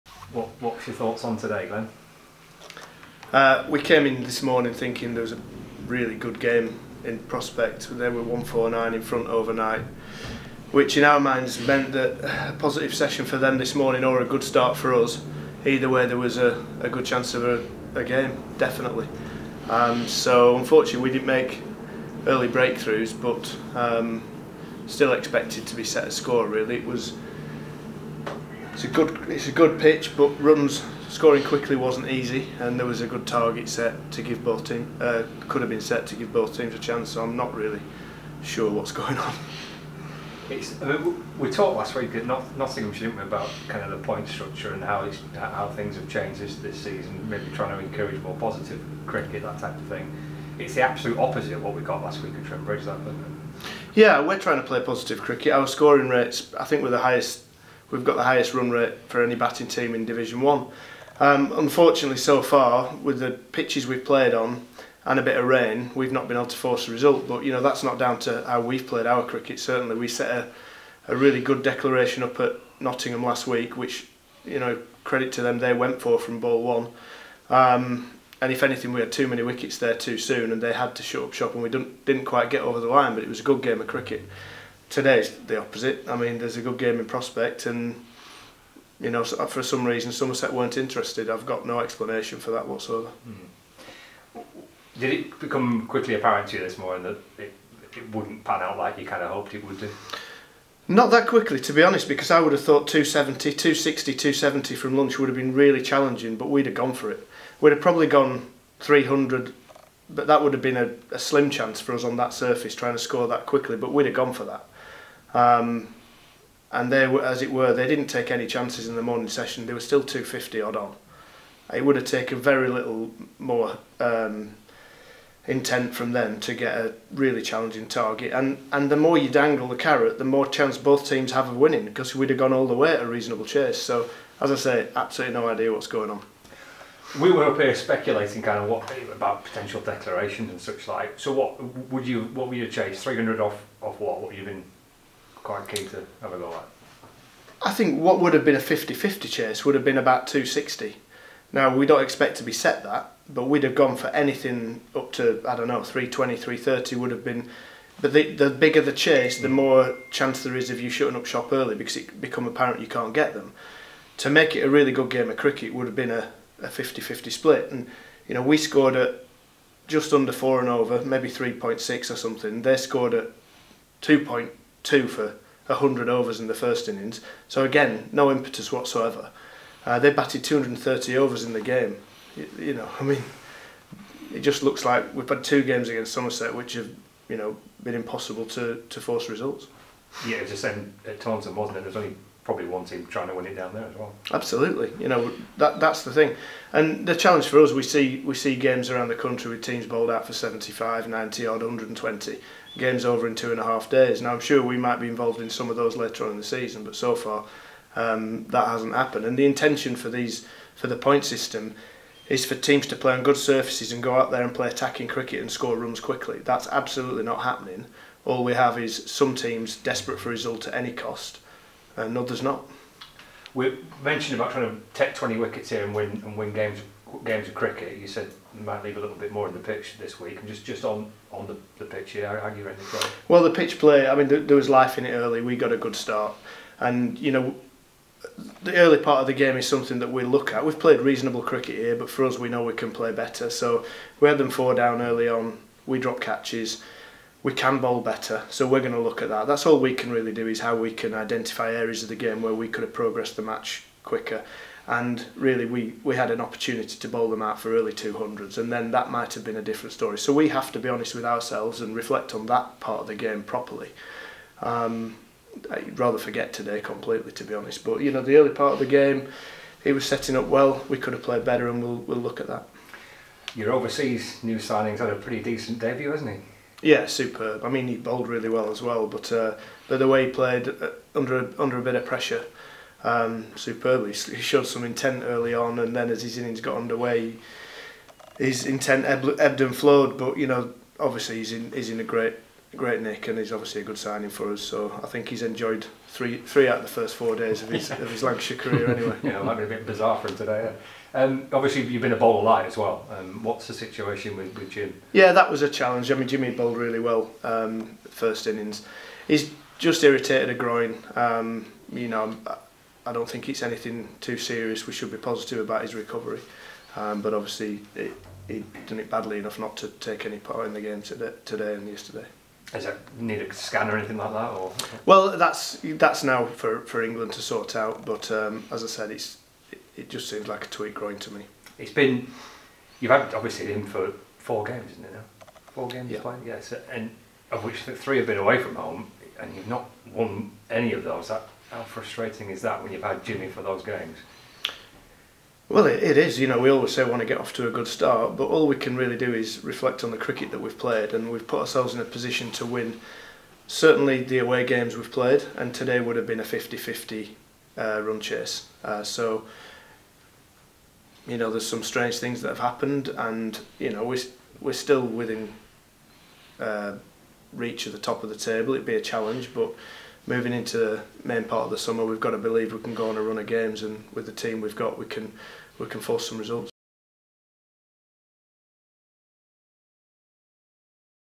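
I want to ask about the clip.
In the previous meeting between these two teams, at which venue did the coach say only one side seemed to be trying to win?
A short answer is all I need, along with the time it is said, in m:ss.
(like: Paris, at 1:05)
Taunton, at 3:11.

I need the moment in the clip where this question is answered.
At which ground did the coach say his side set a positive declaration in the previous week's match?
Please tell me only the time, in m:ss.
0:52.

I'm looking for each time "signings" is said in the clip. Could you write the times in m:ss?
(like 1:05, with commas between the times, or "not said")
4:34, 4:53.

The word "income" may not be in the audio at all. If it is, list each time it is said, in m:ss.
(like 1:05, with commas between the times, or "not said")
not said.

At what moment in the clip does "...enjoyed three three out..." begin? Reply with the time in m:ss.
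4:55.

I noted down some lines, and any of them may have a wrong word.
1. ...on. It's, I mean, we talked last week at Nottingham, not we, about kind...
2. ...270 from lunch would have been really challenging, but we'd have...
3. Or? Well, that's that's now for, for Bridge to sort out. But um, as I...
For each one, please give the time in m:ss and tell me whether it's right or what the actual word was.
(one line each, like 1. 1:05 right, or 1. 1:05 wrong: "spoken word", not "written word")
1. 0:39 right
2. 1:44 right
3. 5:24 wrong: "England", not "Bridge".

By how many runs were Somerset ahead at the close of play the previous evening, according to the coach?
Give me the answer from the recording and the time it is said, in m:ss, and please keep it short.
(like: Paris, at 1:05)
149, at 0:08.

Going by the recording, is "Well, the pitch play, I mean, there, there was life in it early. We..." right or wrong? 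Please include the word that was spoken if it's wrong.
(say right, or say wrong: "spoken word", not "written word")
right.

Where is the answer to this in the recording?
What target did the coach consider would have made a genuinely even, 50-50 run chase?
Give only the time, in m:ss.
2:29.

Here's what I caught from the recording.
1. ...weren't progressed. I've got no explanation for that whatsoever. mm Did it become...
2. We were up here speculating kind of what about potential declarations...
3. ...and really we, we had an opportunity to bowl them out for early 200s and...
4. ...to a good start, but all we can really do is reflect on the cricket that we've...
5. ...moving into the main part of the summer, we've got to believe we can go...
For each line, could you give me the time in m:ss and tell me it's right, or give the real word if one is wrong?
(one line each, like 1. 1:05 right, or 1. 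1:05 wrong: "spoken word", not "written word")
1. 1:30 wrong: "interested", not "progressed"
2. 2:17 right
3. 4:14 right
4. 5:47 right
5. 6:10 right.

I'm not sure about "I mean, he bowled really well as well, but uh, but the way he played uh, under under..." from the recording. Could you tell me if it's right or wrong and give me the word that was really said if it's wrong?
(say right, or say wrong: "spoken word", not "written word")
right.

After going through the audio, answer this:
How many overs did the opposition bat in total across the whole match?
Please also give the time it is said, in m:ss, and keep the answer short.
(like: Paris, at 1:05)
230, at 3:00.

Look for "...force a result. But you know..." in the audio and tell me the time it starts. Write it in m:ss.
1:06.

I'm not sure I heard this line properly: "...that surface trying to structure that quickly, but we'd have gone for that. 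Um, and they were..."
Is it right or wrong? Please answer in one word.
wrong.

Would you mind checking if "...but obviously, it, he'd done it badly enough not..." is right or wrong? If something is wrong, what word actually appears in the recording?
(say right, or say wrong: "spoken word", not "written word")
right.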